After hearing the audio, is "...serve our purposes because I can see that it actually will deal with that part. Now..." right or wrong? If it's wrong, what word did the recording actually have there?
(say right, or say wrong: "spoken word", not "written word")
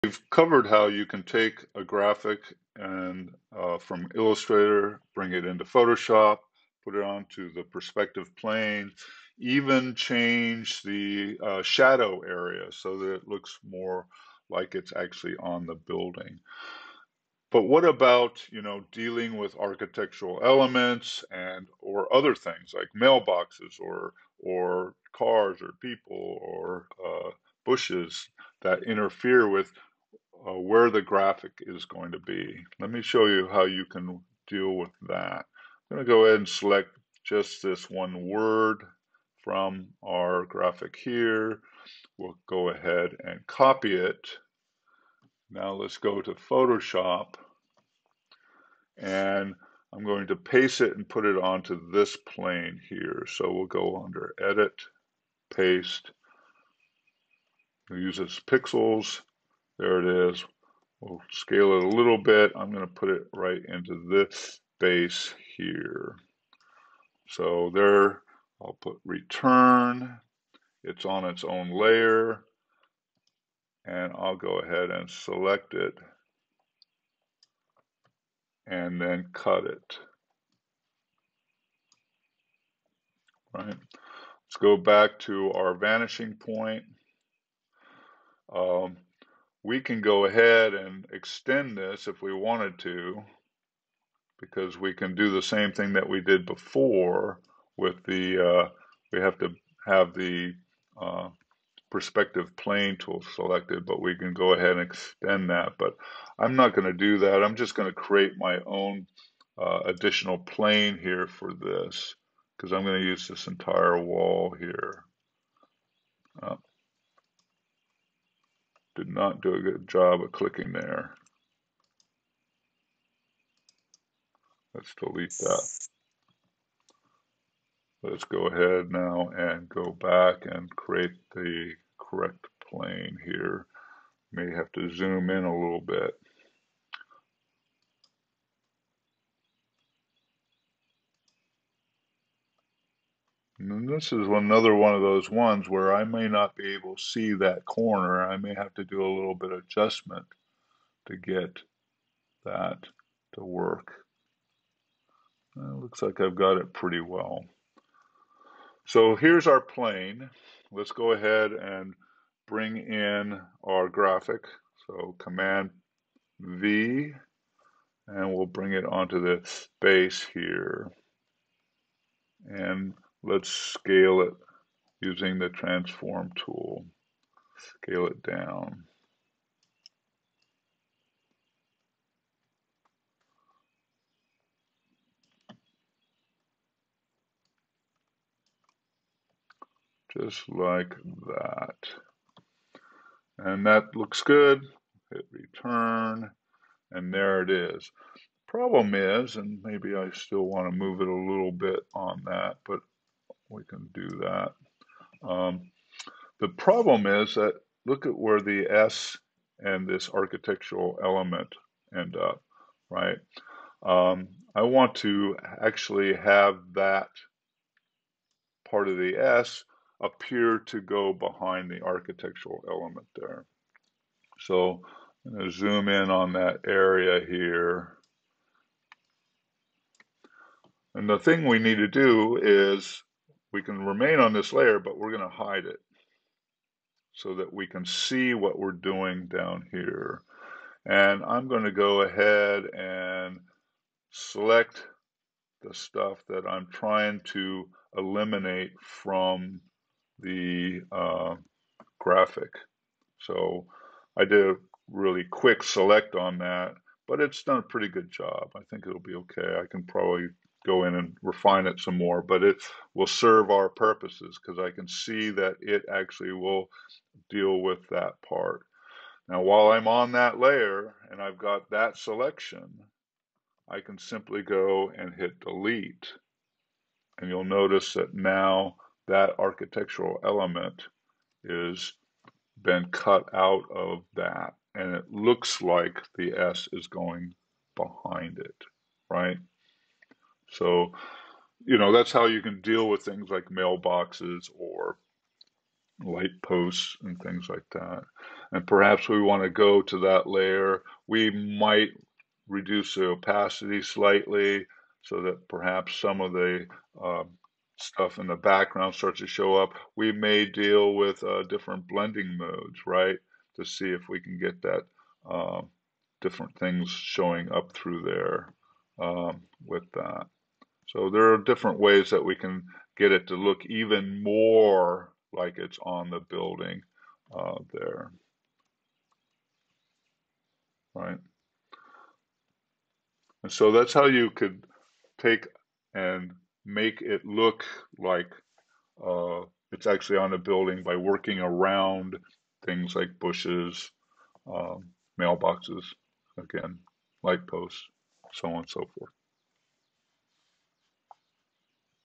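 right.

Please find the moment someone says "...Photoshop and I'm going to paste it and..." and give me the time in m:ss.
0:46.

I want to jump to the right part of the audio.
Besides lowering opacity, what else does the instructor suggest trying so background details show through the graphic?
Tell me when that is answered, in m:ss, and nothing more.
5:11.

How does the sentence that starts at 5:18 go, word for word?
Um, so there are different ways that we can get it to look even more like it's on the building uh, there.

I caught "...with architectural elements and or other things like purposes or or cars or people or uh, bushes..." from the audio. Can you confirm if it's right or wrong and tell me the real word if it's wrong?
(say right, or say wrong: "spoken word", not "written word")
wrong: "mailboxes", not "purposes".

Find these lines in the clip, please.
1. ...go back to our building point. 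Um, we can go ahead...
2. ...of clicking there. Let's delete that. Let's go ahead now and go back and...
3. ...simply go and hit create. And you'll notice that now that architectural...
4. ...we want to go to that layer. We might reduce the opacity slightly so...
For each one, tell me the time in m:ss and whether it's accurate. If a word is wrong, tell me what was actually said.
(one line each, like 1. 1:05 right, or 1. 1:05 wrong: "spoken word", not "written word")
1. 1:24 wrong: "vanishing", not "building"
2. 2:00 right
3. 4:33 wrong: "delete", not "create"
4. 4:59 right.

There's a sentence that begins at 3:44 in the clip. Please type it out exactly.
So I'm going to zoom in on that area here.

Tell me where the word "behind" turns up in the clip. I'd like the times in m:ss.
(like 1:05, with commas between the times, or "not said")
3:41, 4:47.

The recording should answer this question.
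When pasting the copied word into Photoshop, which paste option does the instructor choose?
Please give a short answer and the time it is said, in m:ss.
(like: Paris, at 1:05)
Pixels, at 0:58.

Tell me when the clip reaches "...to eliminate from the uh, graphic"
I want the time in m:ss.
4:07.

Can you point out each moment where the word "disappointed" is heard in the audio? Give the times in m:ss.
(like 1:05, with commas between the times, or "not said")
not said.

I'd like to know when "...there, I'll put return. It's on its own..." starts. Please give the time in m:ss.
1:07.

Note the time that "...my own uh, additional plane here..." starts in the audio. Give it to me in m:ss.
1:48.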